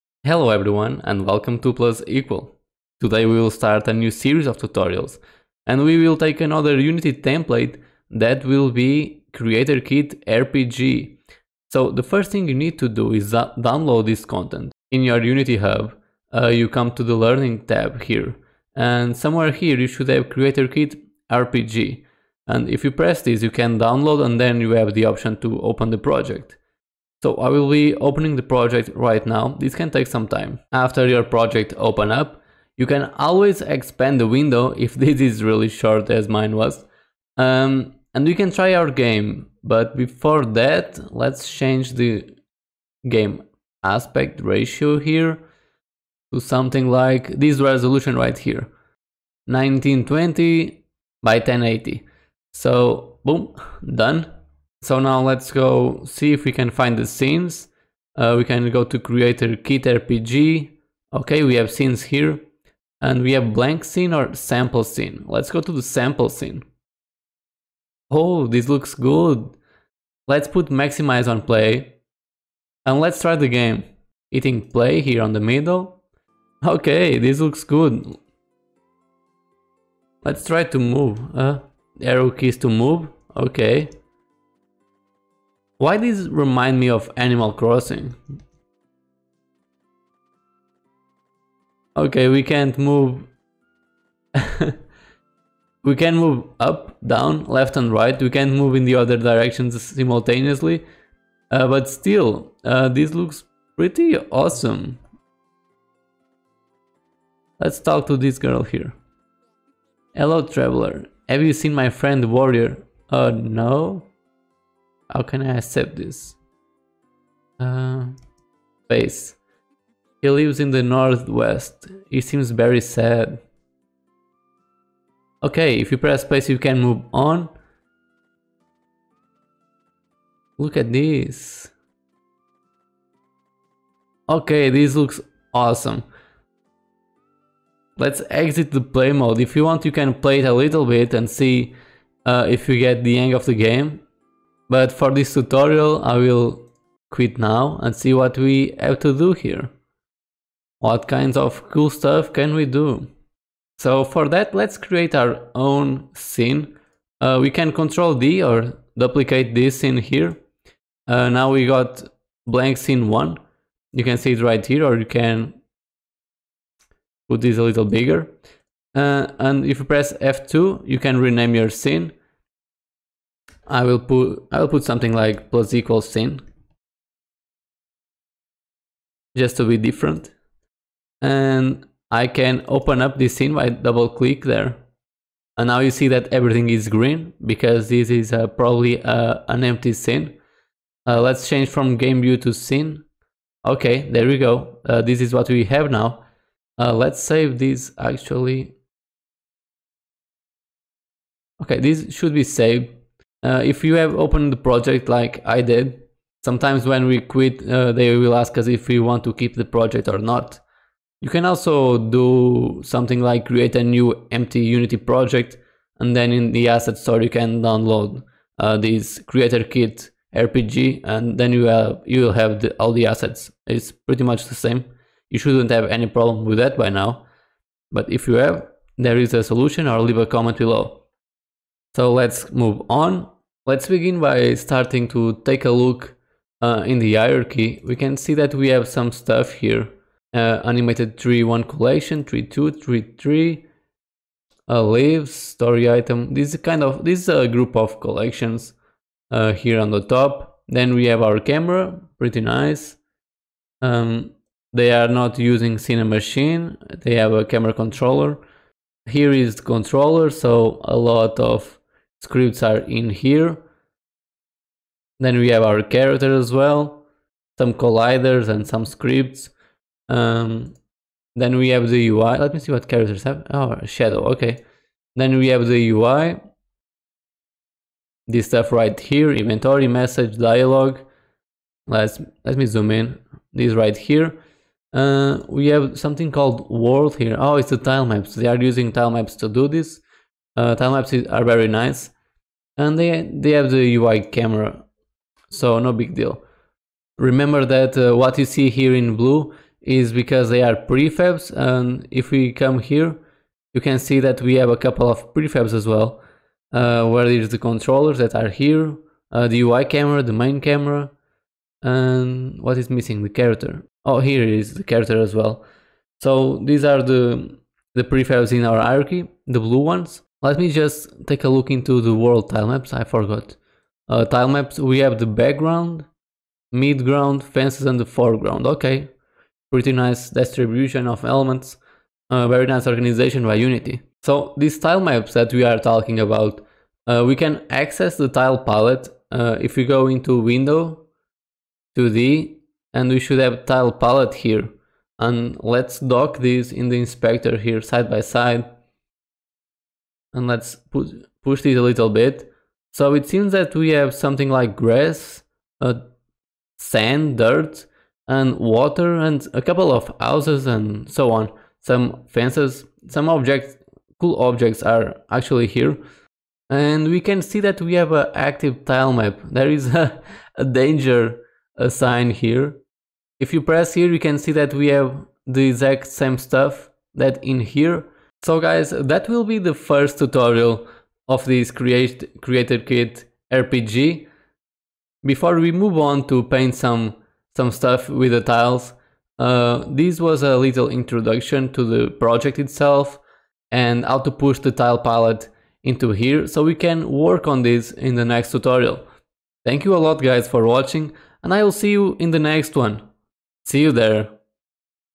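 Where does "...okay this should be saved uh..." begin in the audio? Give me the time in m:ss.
3:21.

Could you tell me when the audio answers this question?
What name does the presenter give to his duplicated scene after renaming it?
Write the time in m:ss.
2:55.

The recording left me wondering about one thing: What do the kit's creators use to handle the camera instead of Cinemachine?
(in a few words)
a camera controller.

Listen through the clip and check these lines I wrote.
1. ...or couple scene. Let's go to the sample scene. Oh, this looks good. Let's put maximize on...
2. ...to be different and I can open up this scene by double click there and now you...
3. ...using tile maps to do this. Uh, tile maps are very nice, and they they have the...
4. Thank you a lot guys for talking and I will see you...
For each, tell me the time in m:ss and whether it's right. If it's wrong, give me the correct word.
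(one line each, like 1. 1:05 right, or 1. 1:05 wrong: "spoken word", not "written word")
1. 1:04 wrong: "sample", not "couple"
2. 2:59 right
3. 4:48 right
4. 6:39 wrong: "watching", not "talking".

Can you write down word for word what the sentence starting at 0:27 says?
So I will be opening the project right now.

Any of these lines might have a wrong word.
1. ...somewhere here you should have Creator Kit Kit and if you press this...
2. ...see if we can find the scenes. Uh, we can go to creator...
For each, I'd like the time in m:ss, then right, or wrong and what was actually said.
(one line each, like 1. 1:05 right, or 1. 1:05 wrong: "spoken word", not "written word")
1. 0:19 wrong: "RPG", not "Kit"
2. 0:56 right.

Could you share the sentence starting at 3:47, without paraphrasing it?
But if you have, there is a solution or leave a comment below.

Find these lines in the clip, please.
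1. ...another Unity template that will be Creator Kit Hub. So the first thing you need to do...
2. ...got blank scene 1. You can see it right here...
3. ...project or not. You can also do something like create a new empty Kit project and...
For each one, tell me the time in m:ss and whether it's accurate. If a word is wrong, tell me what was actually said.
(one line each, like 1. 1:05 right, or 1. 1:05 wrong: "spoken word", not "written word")
1. 0:06 wrong: "RPG", not "Hub"
2. 2:41 right
3. 3:29 wrong: "Unity", not "Kit".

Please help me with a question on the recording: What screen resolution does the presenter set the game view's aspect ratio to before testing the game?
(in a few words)
1920 by 1080.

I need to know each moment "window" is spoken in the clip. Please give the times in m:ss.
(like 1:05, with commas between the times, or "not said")
0:34, 5:40.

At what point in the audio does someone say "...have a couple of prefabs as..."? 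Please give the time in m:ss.
5:04.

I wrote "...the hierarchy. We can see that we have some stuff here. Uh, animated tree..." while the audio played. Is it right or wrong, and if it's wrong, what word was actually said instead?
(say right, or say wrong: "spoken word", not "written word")
right.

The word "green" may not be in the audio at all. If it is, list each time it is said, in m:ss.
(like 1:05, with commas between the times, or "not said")
3:06.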